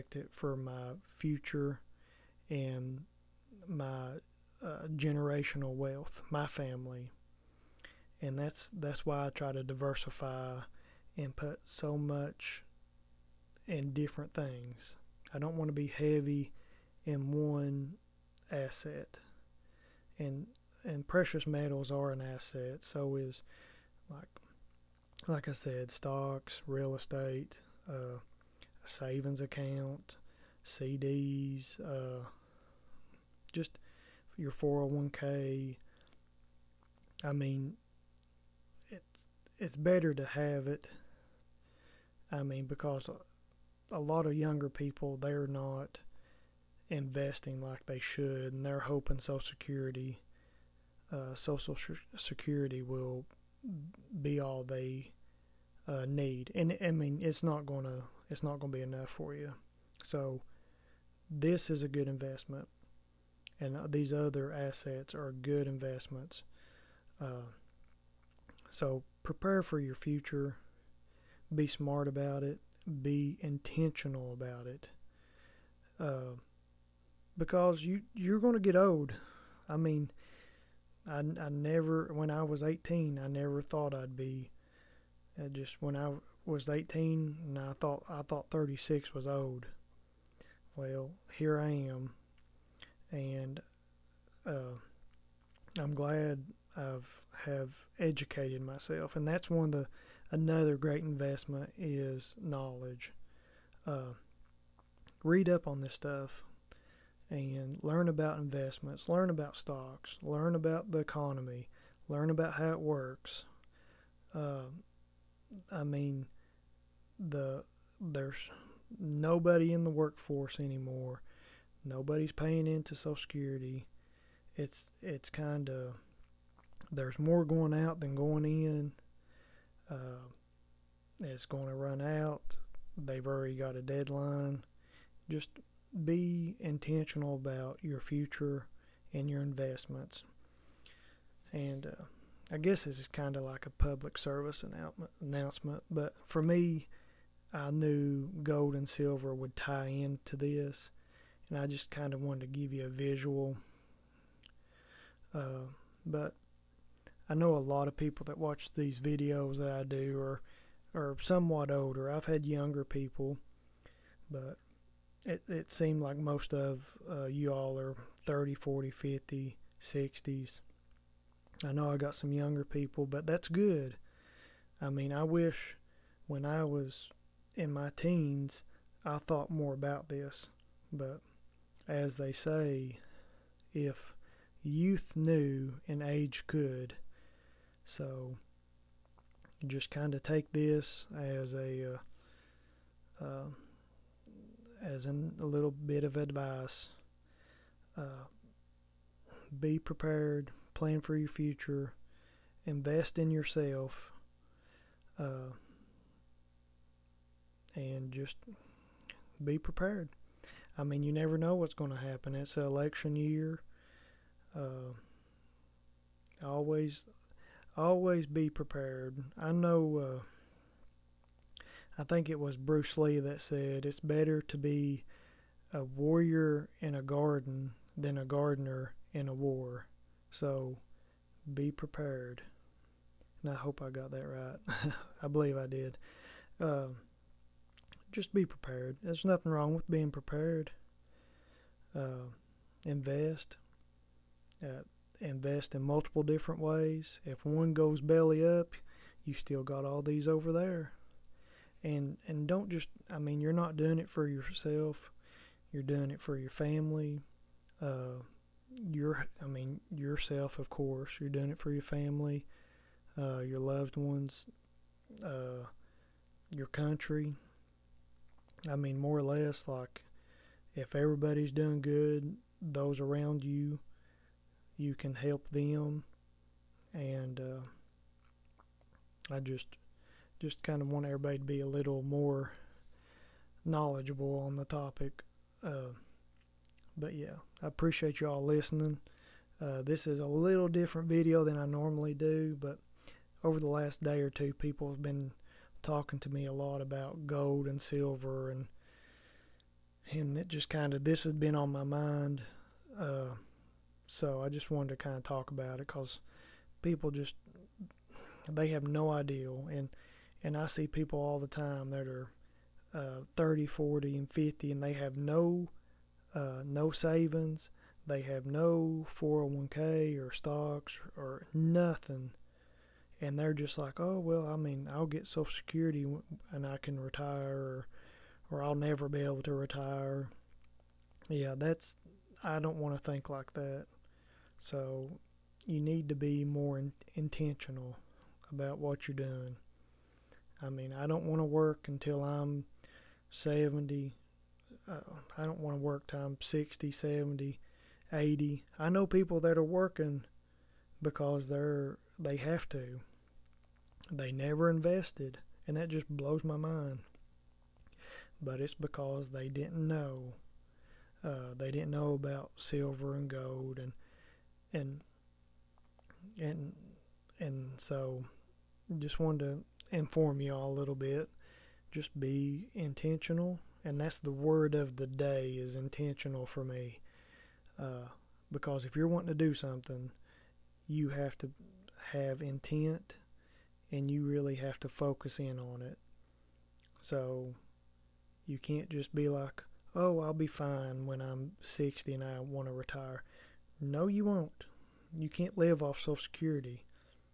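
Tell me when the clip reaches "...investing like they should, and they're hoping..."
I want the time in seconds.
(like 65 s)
46 s.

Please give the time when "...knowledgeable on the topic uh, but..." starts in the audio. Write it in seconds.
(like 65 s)
283 s.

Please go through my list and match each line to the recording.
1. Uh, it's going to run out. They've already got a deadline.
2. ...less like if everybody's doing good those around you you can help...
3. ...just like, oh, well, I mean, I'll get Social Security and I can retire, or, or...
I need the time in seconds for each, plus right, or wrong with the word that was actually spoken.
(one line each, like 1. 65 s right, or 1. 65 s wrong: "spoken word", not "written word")
1. 129 s right
2. 269 s right
3. 323 s right.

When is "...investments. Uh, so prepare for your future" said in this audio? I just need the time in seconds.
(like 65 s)
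65 s.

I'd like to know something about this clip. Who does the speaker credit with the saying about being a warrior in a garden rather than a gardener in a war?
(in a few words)
Bruce Lee.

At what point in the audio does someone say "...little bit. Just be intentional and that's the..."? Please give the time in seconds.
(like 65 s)
370 s.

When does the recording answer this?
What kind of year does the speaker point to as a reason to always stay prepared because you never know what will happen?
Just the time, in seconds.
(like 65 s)
212 s.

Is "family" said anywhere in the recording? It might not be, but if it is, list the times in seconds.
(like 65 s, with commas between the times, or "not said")
6 s, 256 s, 261 s.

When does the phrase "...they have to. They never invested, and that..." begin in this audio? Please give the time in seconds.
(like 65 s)
352 s.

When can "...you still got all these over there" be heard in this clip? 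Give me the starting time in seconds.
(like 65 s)
249 s.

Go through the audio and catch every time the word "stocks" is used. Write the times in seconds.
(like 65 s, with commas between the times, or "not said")
25 s, 109 s, 320 s.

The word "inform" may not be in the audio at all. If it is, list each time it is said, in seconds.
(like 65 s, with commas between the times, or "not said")
369 s.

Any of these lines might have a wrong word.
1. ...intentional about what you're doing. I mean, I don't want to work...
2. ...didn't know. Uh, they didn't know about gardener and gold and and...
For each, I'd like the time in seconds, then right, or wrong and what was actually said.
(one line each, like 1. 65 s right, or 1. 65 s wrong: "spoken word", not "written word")
1. 337 s right
2. 359 s wrong: "silver", not "gardener".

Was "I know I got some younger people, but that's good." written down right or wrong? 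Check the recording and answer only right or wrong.
right.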